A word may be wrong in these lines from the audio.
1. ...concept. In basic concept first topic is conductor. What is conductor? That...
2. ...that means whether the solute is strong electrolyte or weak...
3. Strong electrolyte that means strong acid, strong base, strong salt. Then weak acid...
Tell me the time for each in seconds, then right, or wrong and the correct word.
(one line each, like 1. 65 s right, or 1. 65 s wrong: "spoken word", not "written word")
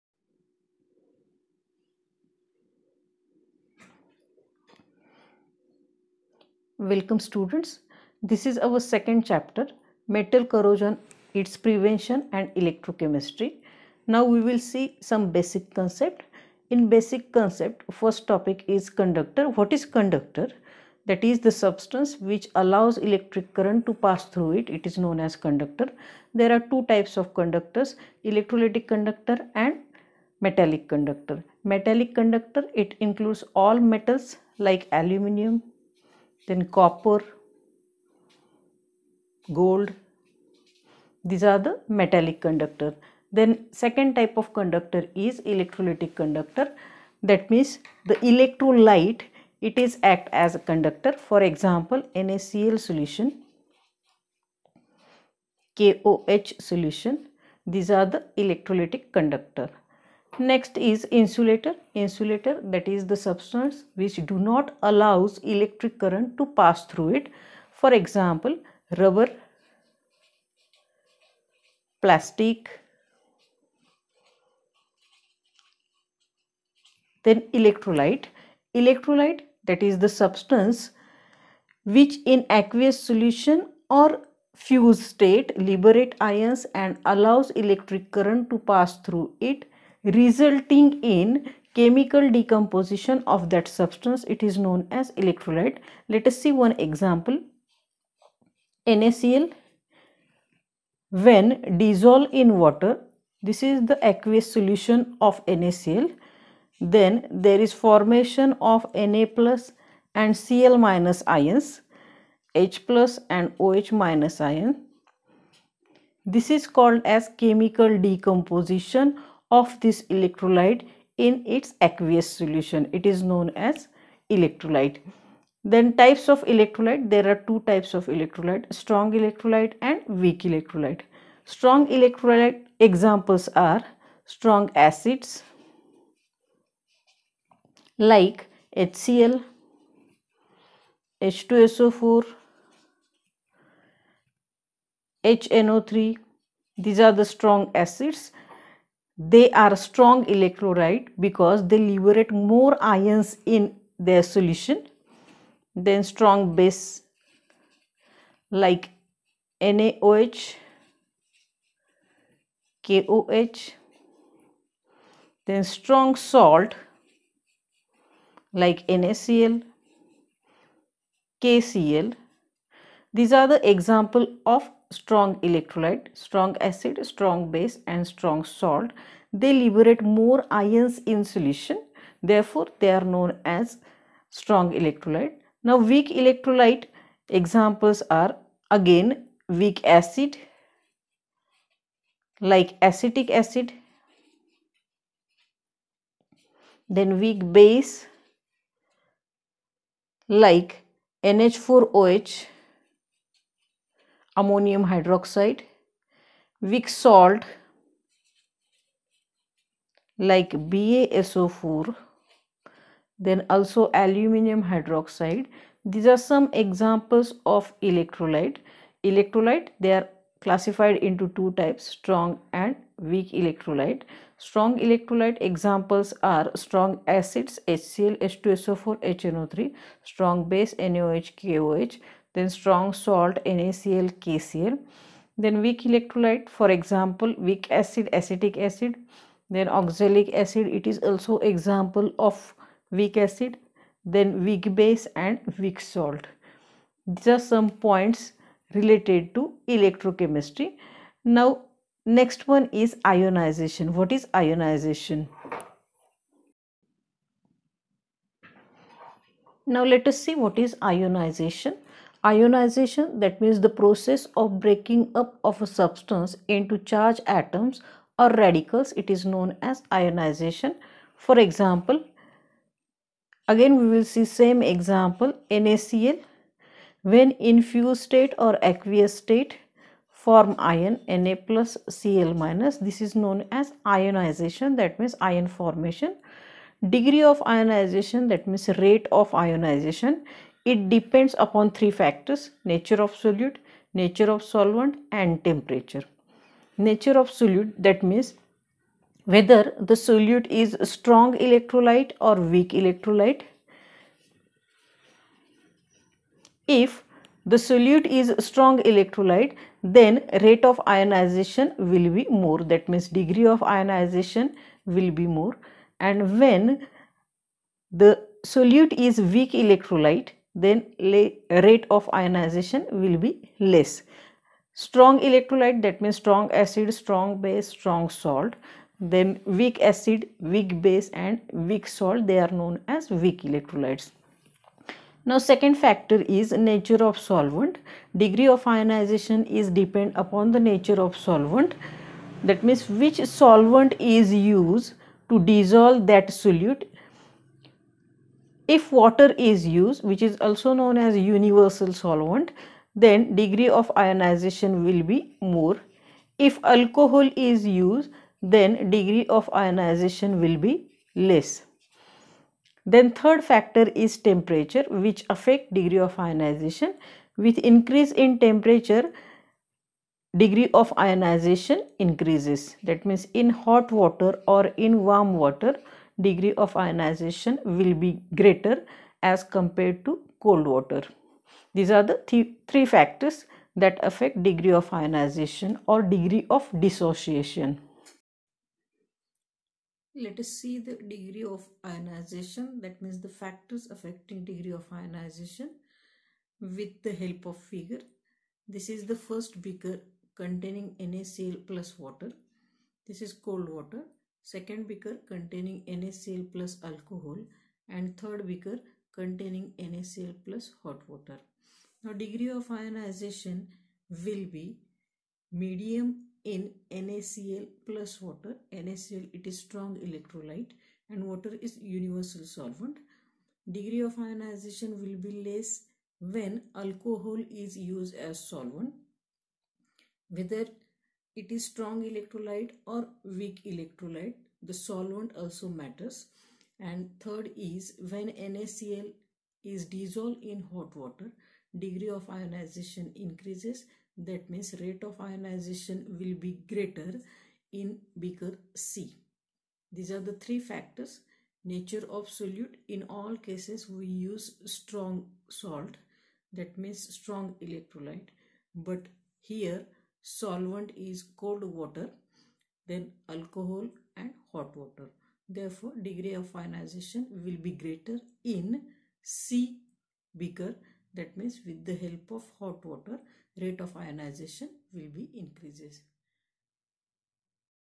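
1. 15 s right
2. 297 s right
3. 324 s right.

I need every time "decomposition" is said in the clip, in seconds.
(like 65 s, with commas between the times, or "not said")
92 s, 117 s.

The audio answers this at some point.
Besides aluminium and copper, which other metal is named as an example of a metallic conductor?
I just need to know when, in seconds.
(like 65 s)
39 s.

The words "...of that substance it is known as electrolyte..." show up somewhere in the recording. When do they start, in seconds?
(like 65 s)
93 s.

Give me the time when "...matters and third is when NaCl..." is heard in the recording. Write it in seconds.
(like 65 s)
435 s.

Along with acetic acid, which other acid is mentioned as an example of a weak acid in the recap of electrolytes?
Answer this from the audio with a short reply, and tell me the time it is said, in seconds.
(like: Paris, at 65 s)
Oxalic acid, at 239 s.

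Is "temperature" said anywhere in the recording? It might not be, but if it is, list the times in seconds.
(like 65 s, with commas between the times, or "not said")
295 s, 364 s, 368 s.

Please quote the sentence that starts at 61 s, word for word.
Insulator that is the substance which do not allows electric current to pass through it.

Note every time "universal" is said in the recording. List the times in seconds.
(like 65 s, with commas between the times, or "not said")
351 s, 421 s.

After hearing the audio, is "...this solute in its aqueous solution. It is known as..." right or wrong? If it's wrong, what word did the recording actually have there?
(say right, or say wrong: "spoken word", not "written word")
wrong: "electrolyte", not "solute".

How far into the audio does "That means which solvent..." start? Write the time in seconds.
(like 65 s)
342 s.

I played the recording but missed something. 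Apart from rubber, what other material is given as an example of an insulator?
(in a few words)
Plastic.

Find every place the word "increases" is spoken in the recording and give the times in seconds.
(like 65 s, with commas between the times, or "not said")
367 s, 371 s, 443 s, 475 s.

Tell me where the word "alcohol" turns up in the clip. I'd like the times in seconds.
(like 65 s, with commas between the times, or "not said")
356 s, 406 s, 426 s, 463 s.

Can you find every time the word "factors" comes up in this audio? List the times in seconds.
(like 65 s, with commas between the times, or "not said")
291 s, 335 s, 363 s, 382 s, 393 s, 450 s.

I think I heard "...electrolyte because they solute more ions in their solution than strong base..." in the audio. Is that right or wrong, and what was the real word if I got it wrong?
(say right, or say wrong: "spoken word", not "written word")
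wrong: "liberate", not "solute".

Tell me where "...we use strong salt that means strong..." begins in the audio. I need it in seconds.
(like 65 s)
453 s.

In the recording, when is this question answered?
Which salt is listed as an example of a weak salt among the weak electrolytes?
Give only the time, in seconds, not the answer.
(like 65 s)
210 s.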